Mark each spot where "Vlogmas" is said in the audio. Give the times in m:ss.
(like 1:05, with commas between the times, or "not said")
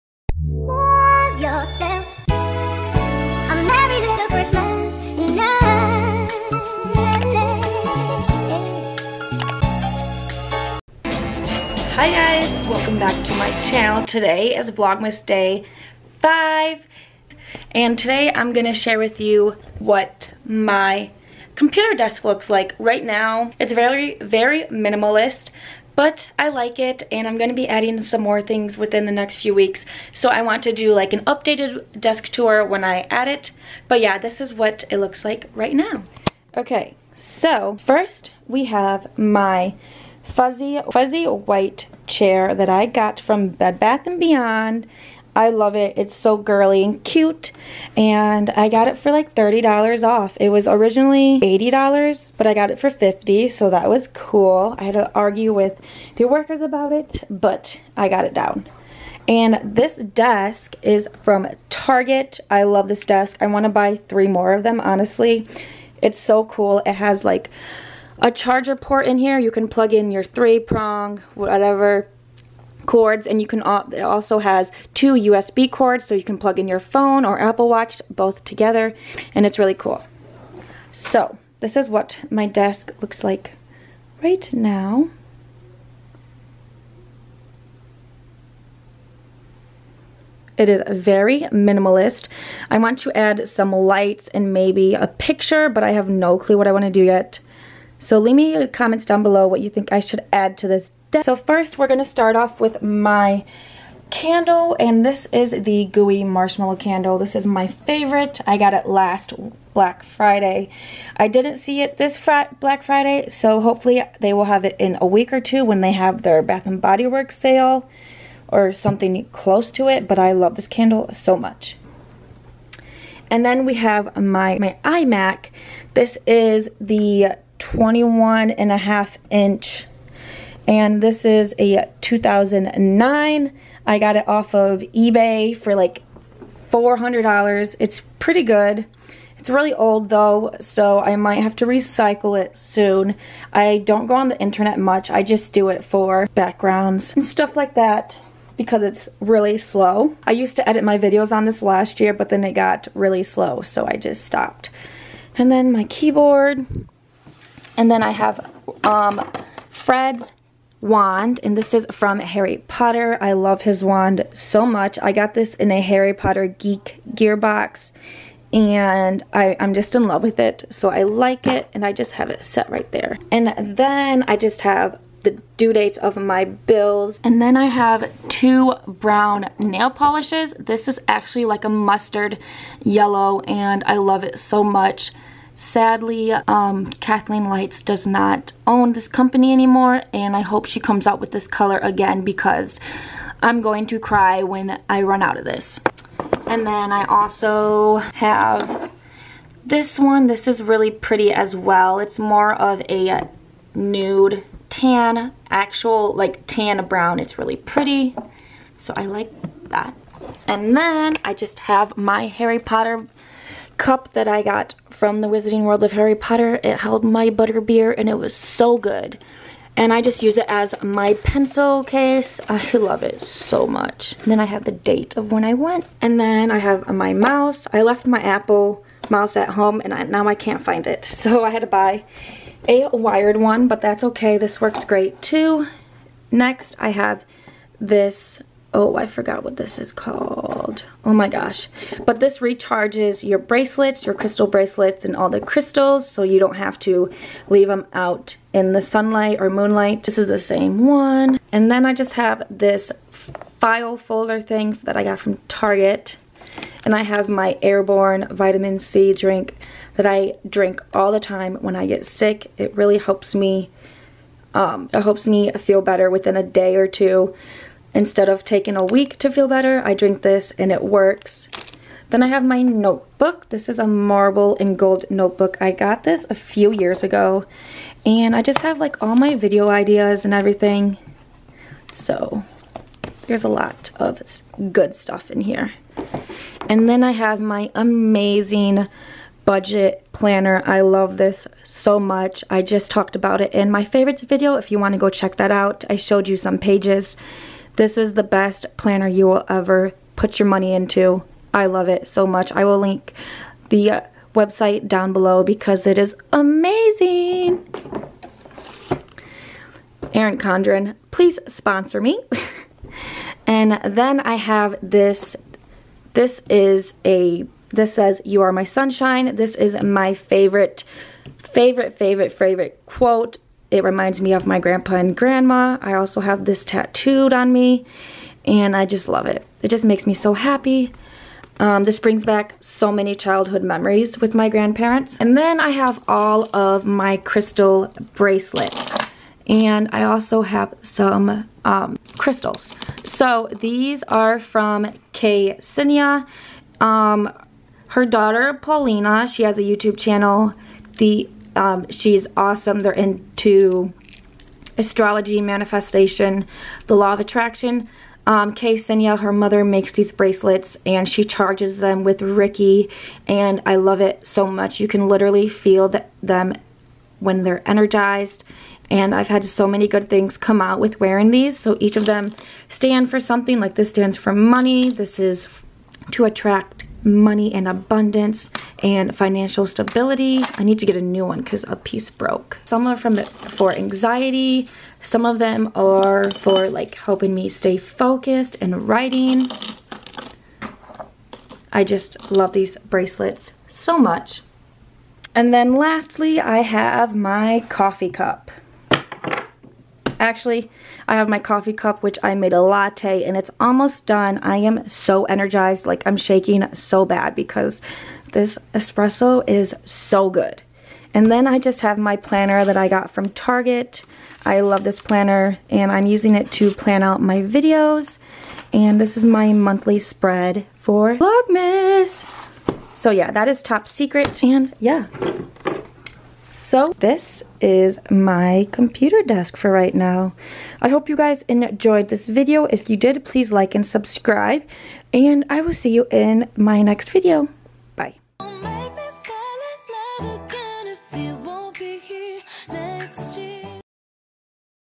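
0:14, 7:01.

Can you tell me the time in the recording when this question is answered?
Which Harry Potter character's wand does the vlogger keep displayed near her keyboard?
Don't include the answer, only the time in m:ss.
2:39.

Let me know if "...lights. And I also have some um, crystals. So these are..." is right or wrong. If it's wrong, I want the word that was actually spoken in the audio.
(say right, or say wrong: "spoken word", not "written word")
wrong: "bracelets", not "lights".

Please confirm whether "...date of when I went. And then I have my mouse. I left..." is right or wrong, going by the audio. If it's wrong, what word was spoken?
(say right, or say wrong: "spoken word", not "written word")
right.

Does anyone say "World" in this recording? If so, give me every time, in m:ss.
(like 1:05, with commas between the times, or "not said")
3:35.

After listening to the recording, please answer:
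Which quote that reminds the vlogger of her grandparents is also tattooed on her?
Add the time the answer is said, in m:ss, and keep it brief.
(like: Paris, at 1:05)
You are my sunshine, at 5:18.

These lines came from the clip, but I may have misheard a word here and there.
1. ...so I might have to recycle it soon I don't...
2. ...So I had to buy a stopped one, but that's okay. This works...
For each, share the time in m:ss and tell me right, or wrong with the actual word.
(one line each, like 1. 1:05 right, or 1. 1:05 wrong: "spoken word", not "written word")
1. 2:20 right
2. 3:51 wrong: "wired", not "stopped".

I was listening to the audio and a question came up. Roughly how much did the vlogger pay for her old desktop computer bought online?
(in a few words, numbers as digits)
$400.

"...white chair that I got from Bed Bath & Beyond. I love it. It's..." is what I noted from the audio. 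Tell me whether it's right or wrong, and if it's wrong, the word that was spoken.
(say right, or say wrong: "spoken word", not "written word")
right.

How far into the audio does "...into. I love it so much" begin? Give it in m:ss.
5:00.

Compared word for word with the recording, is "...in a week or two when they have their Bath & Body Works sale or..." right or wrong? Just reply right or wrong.
right.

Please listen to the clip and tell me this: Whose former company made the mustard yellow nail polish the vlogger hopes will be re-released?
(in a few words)
Kathleen Lights.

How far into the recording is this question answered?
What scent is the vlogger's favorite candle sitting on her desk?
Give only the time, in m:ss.
1:45.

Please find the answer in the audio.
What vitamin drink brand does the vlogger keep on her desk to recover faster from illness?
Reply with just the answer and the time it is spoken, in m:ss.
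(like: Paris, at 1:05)
Airborne, at 4:17.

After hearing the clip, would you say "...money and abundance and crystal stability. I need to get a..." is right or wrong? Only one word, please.
wrong.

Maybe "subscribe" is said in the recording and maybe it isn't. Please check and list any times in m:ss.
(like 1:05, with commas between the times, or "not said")
7:13.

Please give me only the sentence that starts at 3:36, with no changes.
It held my butterbeer and it was so good.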